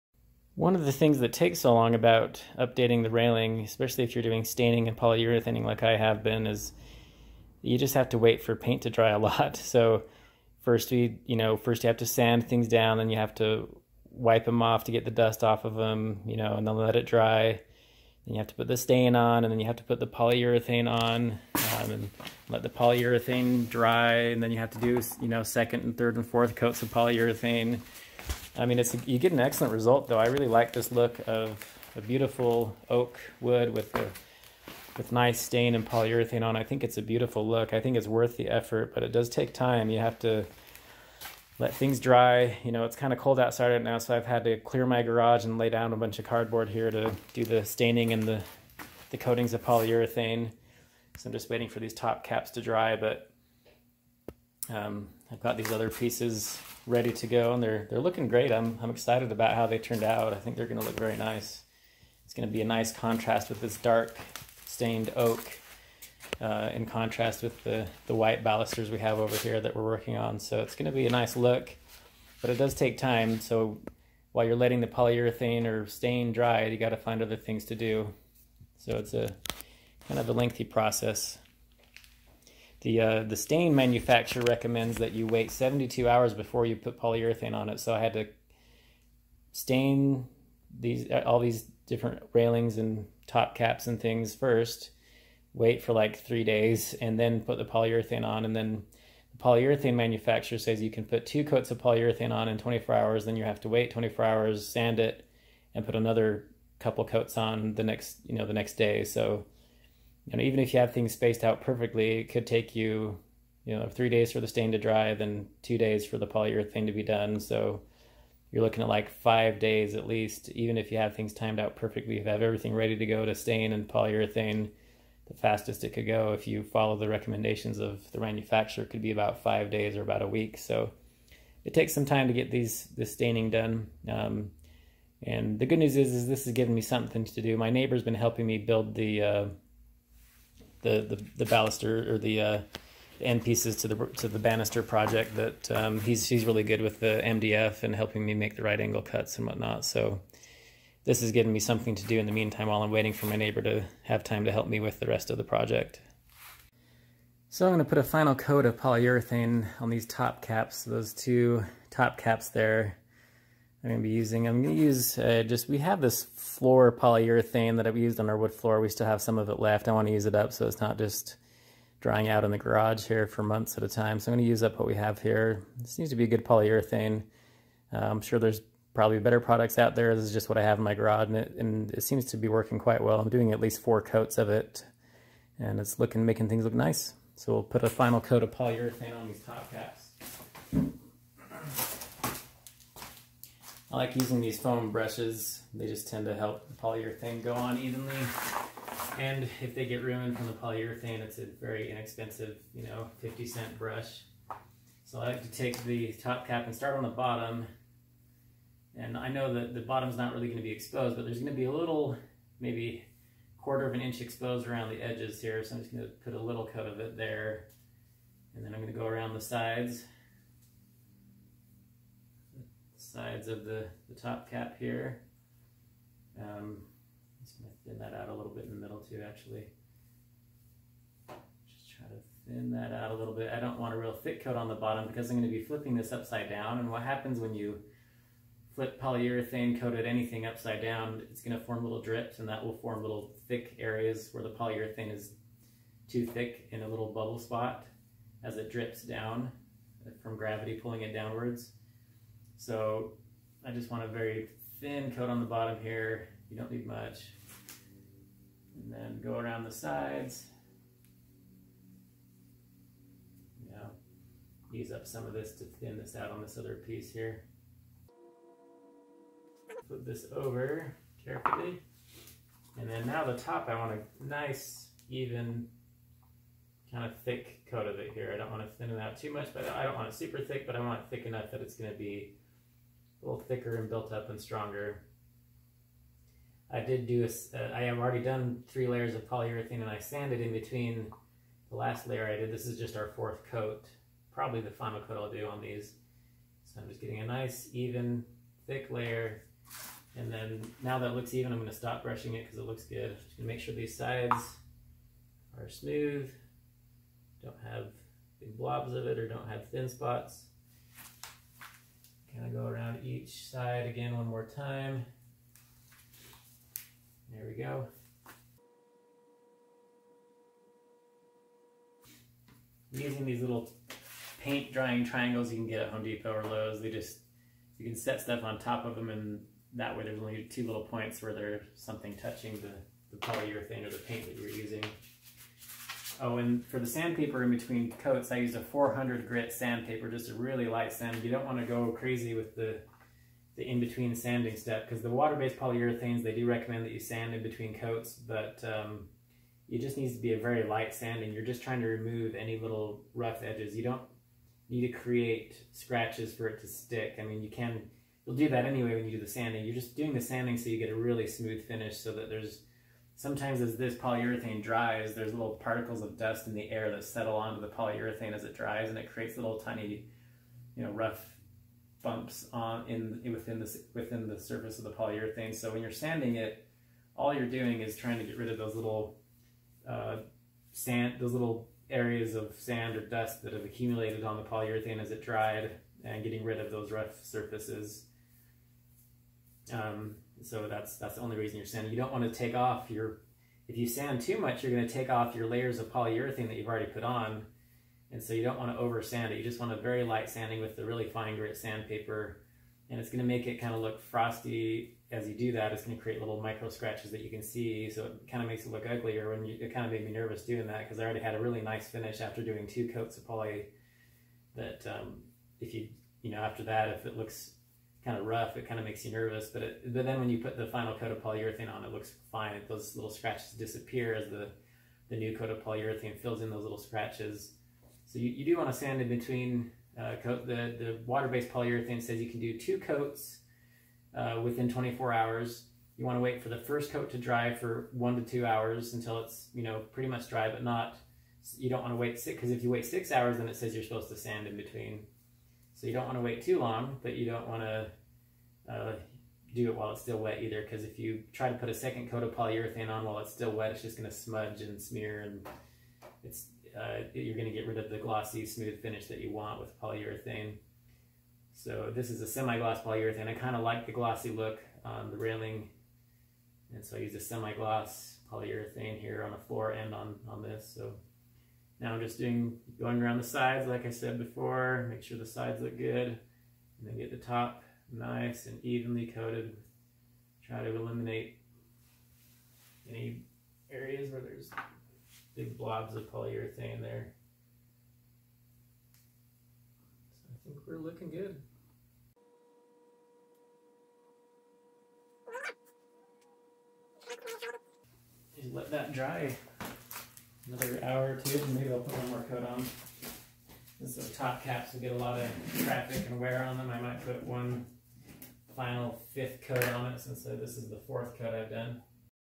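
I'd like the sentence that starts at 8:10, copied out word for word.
So I think we're looking good.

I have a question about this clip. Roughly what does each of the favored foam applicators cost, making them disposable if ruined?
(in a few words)
50 cents.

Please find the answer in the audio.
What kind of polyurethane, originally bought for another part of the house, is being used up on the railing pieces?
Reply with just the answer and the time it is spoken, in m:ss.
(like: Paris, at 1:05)
floor polyurethane, at 2:46.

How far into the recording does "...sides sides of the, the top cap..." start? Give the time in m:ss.
3:39.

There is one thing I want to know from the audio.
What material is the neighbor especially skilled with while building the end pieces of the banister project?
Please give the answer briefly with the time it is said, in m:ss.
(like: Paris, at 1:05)
MDF, at 2:27.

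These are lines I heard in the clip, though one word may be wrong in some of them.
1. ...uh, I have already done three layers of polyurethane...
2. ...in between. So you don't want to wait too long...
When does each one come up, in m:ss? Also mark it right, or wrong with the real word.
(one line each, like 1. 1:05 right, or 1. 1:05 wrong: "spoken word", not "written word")
1. 4:47 right
2. 7:24 right.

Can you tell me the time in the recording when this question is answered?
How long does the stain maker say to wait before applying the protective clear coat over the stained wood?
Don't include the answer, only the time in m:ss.
1:25.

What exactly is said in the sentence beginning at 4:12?
So I just want a very thin coat on the bottom here.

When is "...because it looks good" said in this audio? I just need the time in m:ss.
5:02.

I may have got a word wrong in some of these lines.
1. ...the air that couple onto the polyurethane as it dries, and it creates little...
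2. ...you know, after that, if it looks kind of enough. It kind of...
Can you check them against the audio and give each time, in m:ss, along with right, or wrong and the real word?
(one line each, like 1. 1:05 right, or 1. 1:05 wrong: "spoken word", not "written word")
1. 6:06 wrong: "settle", not "couple"
2. 6:56 wrong: "rough", not "enough".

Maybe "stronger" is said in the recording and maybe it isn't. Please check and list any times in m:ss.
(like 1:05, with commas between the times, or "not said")
4:44.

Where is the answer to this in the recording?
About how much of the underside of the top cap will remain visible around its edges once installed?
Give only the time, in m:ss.
3:33.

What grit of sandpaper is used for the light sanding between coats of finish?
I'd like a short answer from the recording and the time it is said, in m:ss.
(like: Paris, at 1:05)
400, at 5:38.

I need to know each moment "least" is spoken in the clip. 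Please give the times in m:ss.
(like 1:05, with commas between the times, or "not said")
2:00, 3:03.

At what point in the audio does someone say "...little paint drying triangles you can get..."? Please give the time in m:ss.
5:23.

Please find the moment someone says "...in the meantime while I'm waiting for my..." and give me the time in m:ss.
2:32.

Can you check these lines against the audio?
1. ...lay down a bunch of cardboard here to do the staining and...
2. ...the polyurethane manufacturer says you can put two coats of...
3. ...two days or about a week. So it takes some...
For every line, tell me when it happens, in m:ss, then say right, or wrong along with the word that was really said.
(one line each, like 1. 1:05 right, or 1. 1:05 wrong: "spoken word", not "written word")
1. 0:45 right
2. 1:39 right
3. 2:09 wrong: "five", not "two".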